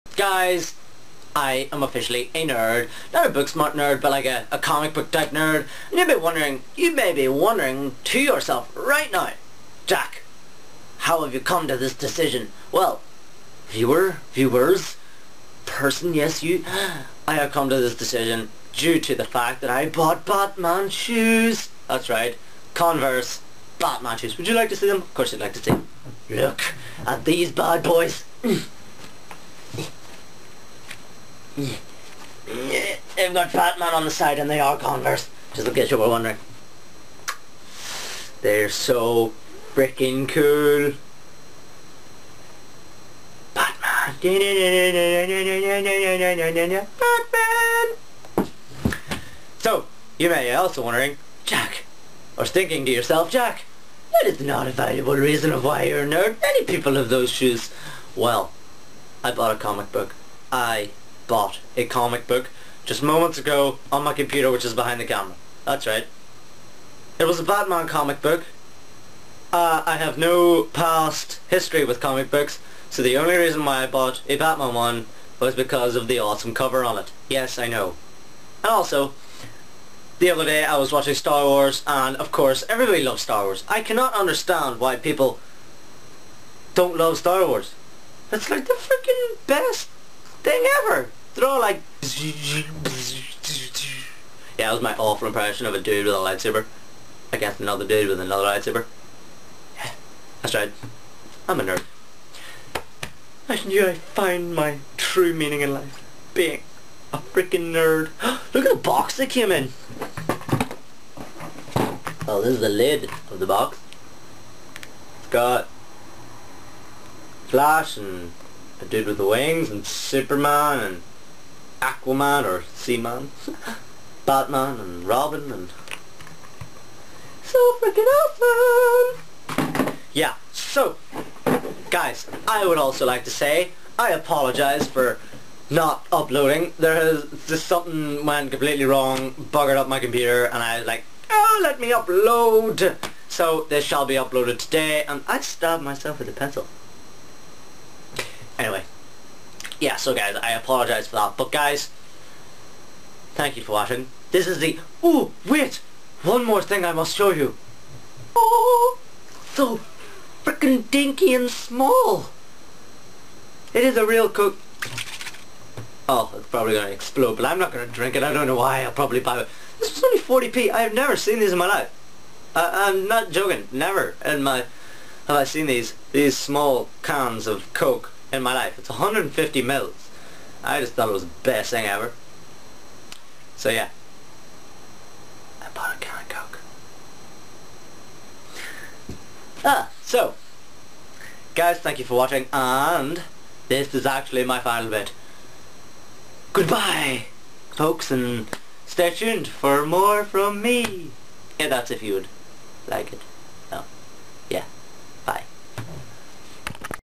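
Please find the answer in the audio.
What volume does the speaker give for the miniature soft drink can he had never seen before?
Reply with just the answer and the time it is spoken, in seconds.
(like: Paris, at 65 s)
150 ml, at 178 s.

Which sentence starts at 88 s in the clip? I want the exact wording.
It's like the freaking best thing ever.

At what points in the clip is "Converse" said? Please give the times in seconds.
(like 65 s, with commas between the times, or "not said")
22 s, 34 s.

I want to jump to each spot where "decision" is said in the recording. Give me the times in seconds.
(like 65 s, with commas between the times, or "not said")
11 s, 17 s.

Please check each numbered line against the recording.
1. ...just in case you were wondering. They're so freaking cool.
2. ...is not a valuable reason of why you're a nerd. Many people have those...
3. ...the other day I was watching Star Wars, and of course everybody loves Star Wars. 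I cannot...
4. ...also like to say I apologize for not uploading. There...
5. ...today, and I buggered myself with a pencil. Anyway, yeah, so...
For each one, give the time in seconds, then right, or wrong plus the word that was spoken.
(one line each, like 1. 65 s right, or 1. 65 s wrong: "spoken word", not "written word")
1. 35 s right
2. 54 s right
3. 80 s right
4. 132 s right
5. 144 s wrong: "stabbed", not "buggered".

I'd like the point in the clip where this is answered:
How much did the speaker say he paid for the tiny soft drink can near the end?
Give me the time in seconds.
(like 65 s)
170 s.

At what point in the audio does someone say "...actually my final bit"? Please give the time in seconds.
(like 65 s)
194 s.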